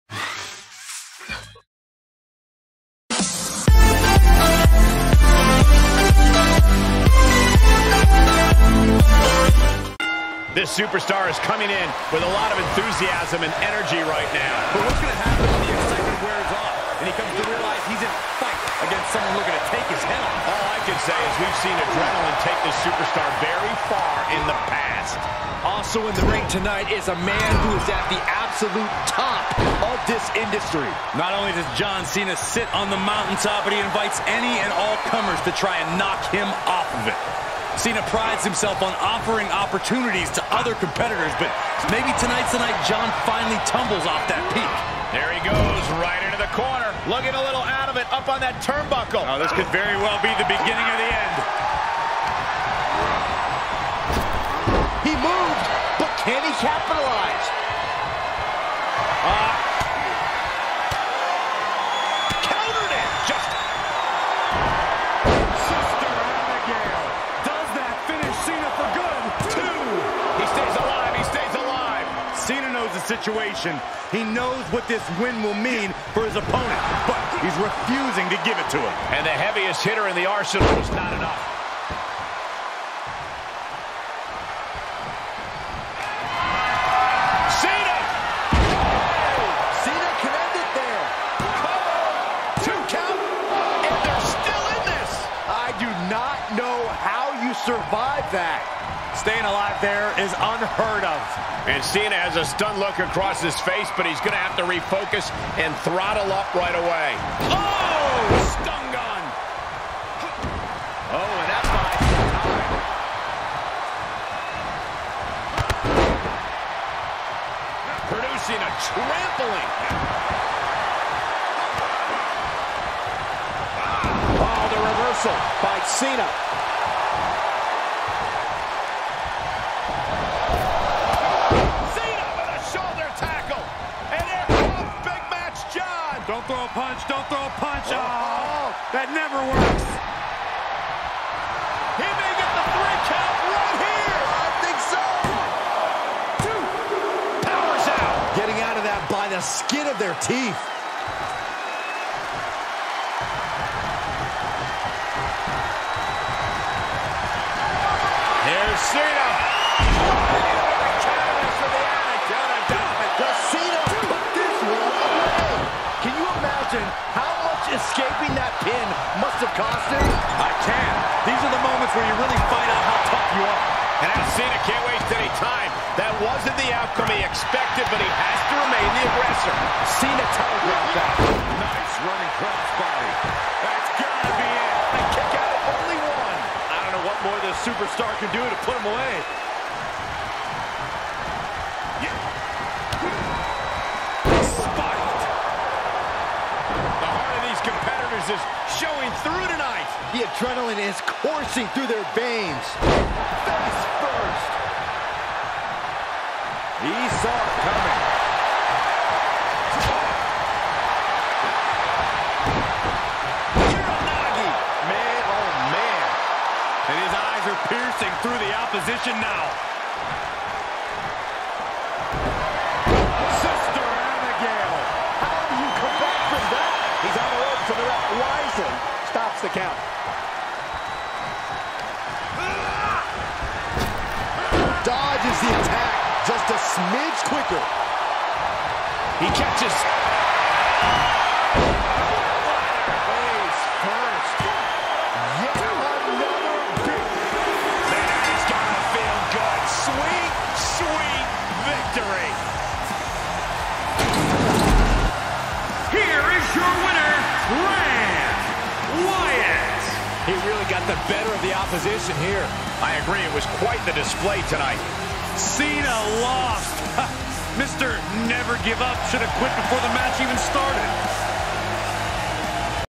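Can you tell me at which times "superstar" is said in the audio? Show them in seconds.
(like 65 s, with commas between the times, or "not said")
10 s, 22 s, 187 s.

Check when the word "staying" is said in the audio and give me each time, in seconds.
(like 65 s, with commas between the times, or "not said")
99 s.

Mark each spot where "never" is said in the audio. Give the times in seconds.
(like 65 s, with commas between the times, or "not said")
139 s, 268 s.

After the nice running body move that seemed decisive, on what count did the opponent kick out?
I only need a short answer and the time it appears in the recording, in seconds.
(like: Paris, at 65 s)
1, at 185 s.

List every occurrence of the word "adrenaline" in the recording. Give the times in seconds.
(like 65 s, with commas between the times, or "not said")
21 s, 200 s.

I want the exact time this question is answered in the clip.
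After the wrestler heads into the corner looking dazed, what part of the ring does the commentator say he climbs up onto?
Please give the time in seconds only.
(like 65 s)
48 s.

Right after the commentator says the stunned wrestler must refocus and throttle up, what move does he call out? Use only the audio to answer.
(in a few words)
stun gun.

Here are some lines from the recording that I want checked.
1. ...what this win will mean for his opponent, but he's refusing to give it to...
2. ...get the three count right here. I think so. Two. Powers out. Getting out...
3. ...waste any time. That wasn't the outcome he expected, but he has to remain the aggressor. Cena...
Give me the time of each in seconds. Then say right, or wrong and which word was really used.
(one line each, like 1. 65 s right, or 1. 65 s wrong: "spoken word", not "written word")
1. 74 s right
2. 142 s right
3. 174 s right.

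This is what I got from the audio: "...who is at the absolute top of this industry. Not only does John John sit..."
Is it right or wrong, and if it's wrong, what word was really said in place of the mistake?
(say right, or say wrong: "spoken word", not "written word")
wrong: "Cena", not "John".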